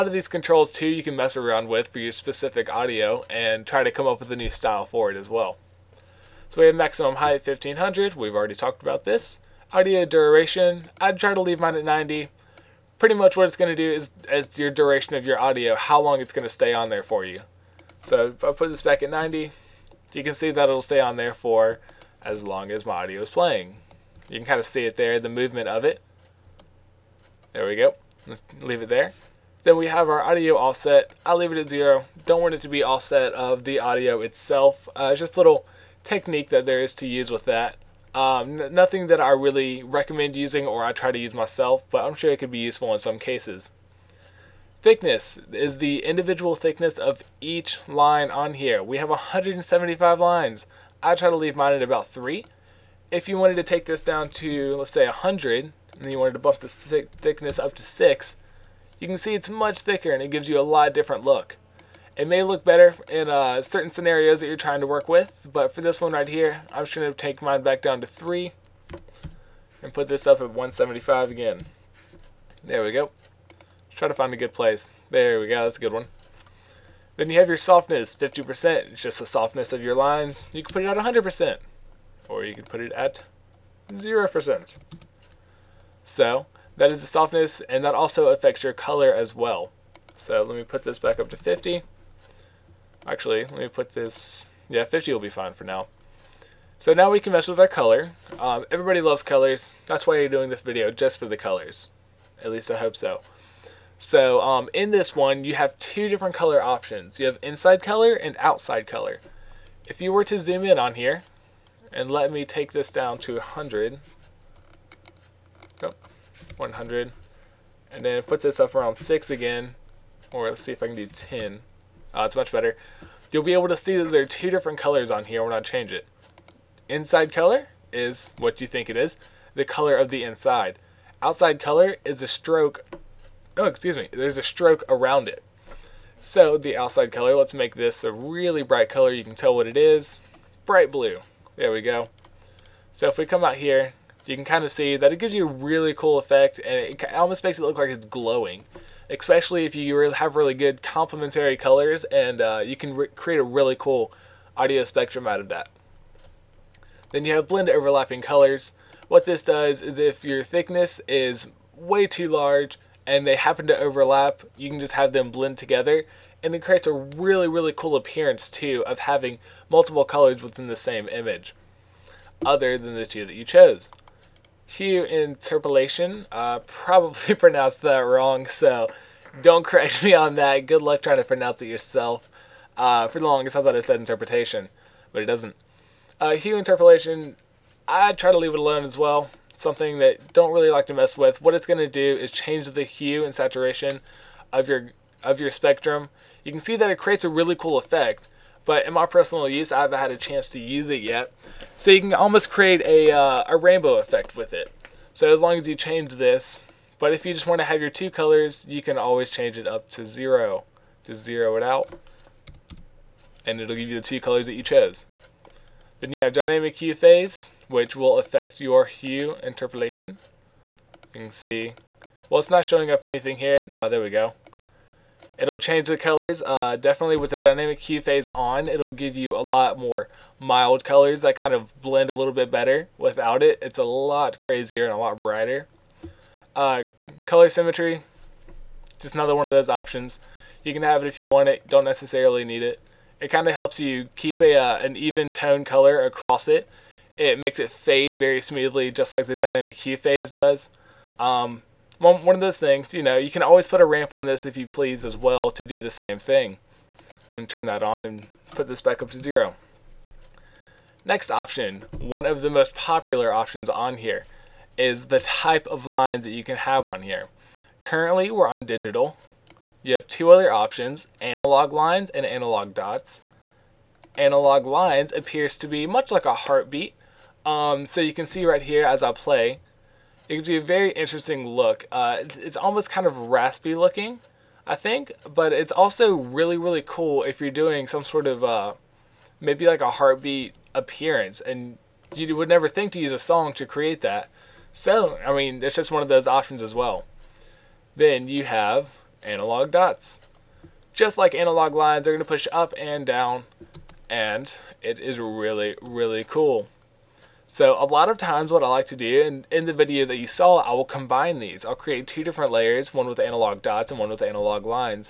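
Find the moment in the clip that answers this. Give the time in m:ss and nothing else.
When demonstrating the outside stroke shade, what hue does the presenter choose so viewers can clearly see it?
2:20.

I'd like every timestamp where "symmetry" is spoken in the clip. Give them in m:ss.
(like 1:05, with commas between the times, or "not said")
3:57.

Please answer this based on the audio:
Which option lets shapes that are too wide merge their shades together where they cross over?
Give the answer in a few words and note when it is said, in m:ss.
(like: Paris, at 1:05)
Blend overlapping colors, at 2:37.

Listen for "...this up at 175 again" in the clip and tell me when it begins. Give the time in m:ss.
1:10.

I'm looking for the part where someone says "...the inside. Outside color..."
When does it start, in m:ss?
2:10.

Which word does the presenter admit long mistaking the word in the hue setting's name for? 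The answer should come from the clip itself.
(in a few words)
interpretation.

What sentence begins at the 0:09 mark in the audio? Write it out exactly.
Audio duration, I'd try to leave mine at 90.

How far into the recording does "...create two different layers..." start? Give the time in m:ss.
5:11.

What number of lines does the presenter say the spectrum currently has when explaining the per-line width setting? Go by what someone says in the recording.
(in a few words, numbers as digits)
175.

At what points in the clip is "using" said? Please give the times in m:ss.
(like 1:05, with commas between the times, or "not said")
0:40.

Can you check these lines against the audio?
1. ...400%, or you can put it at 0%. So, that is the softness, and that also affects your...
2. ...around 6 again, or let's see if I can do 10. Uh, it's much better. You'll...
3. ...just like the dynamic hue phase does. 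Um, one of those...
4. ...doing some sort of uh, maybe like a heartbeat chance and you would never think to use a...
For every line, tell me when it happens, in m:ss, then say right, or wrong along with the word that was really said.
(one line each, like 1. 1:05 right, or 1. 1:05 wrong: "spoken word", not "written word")
1. 1:20 wrong: "100", not "400"
2. 1:58 right
3. 4:08 right
4. 4:47 wrong: "appearance", not "chance".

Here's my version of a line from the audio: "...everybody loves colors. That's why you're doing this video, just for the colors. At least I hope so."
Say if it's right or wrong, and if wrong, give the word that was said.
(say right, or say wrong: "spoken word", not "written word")
right.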